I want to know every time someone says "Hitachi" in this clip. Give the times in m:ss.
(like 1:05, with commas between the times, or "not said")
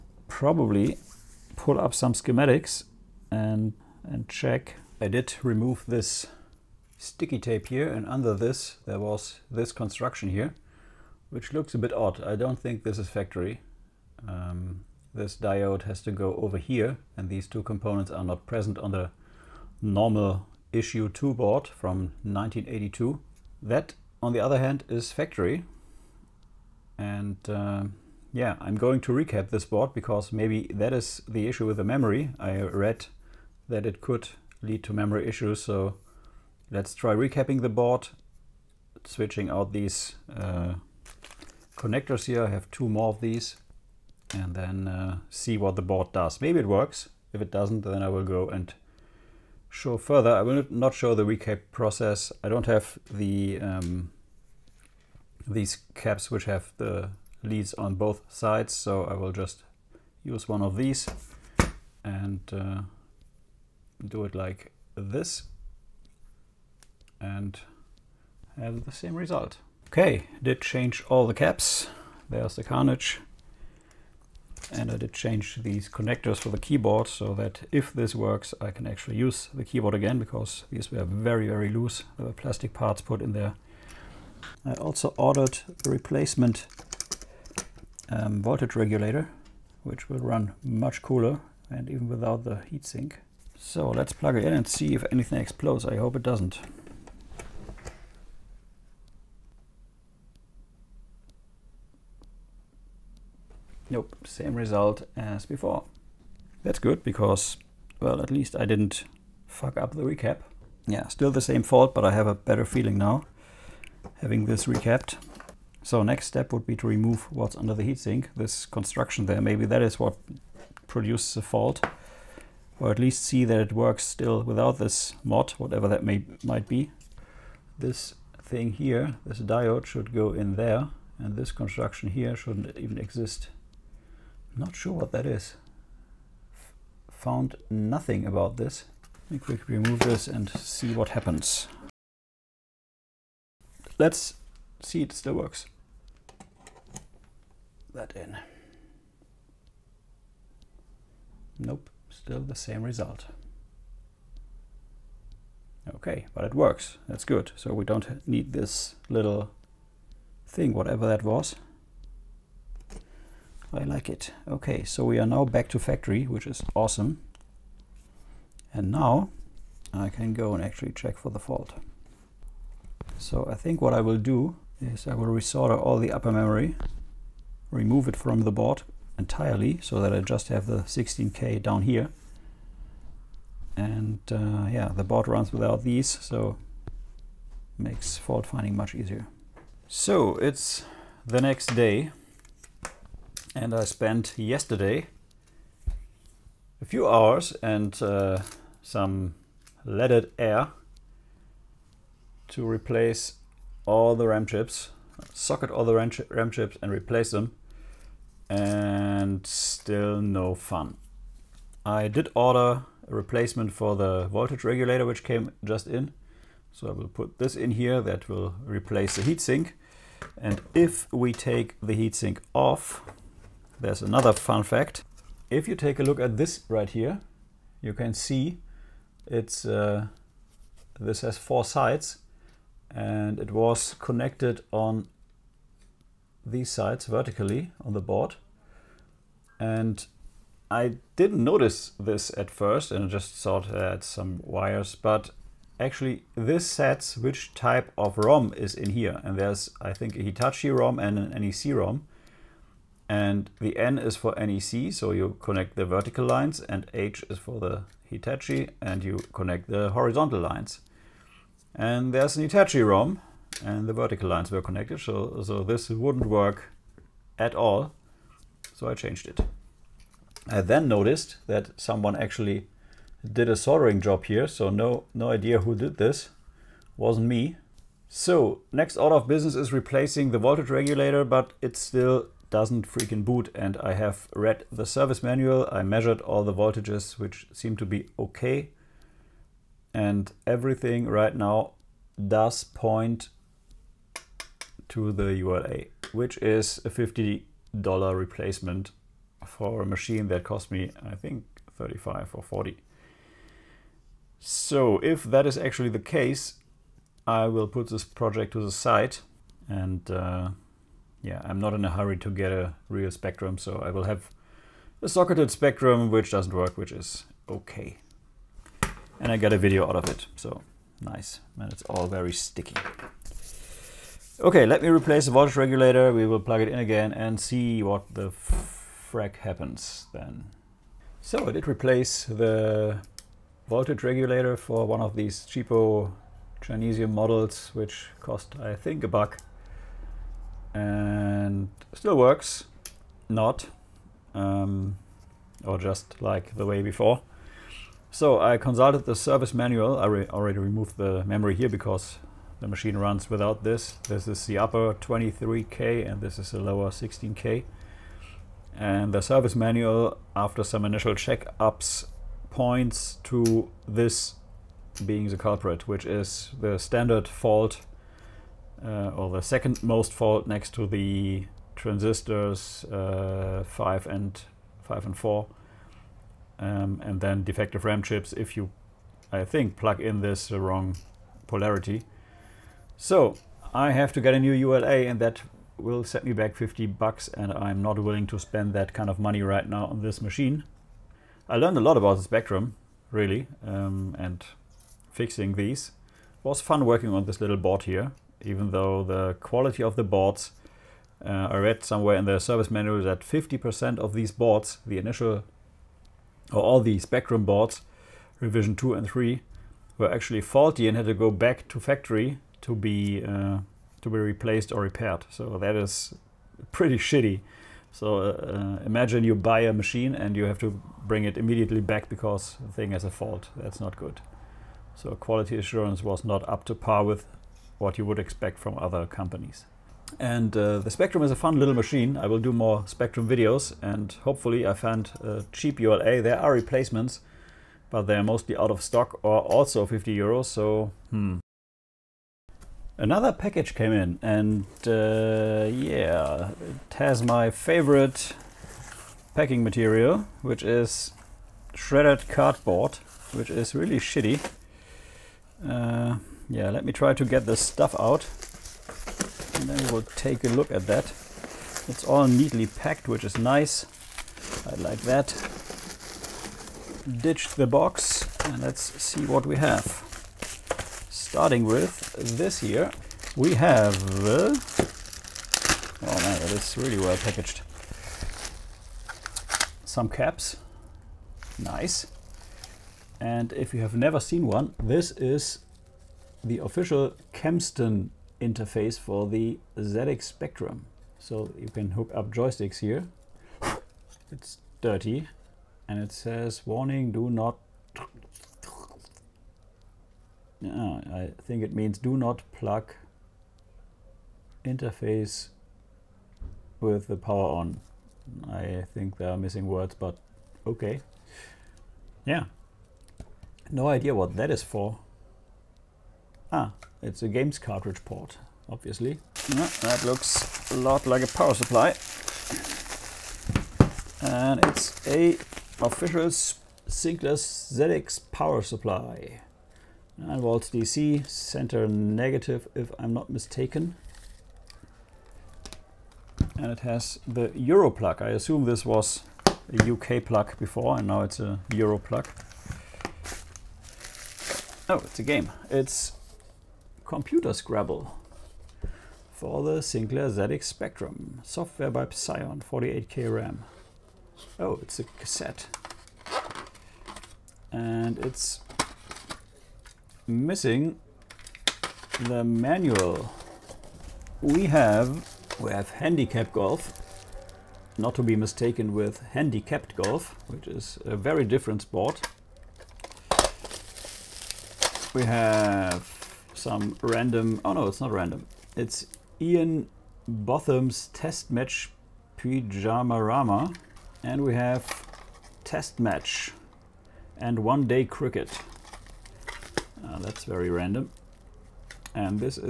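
4:10, 4:18, 4:22.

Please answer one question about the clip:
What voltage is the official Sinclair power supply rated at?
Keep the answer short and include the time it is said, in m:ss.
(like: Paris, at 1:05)
9 volts, at 8:50.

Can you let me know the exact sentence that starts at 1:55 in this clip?
So next step would be to remove what's under the heatsink, this construction there.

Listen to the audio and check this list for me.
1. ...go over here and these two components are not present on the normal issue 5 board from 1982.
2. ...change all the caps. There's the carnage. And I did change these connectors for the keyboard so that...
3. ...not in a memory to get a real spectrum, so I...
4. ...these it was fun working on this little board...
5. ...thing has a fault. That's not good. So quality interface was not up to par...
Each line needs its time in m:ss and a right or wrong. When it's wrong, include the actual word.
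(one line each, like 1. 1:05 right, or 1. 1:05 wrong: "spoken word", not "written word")
1. 0:16 wrong: "2", not "5"
2. 1:10 right
3. 5:11 wrong: "hurry", not "memory"
4. 6:35 right
5. 7:02 wrong: "assurance", not "interface".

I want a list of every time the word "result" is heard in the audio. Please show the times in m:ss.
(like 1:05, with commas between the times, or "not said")
1:09, 1:44, 2:32.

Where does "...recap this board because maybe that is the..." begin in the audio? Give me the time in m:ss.
0:29.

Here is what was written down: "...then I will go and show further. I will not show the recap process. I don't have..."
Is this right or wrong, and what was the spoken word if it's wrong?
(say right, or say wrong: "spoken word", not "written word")
right.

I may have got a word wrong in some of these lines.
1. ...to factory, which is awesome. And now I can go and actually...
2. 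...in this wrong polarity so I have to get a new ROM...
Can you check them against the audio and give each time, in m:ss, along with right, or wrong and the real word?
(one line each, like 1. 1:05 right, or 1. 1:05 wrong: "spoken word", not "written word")
1. 2:45 right
2. 6:20 wrong: "ULA", not "ROM".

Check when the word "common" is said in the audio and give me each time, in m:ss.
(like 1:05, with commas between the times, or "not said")
not said.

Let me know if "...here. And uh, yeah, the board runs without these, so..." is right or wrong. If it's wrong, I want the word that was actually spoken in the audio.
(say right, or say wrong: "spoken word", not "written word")
right.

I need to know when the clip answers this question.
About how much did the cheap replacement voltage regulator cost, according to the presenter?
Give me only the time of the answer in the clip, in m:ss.
5:39.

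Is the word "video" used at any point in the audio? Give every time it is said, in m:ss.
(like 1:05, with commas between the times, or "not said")
5:19, 7:13.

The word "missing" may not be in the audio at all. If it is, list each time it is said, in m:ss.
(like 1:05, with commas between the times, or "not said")
8:29, 9:20.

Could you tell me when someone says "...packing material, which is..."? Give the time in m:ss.
7:29.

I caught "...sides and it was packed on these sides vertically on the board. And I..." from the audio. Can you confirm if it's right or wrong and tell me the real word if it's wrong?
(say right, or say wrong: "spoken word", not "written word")
wrong: "connected", not "packed".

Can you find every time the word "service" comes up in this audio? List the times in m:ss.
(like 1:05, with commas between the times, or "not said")
4:44, 5:49, 5:59, 6:42.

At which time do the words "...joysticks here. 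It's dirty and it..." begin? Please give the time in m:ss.
8:12.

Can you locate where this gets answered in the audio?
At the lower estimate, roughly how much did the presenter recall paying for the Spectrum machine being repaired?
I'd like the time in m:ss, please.
5:01.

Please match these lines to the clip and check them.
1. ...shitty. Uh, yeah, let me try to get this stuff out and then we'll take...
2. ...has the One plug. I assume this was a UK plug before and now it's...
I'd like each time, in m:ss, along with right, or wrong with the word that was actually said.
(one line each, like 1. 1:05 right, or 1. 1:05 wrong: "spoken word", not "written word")
1. 7:33 right
2. 8:56 wrong: "Euro", not "One".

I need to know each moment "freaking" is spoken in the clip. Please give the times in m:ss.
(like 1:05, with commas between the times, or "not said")
4:42.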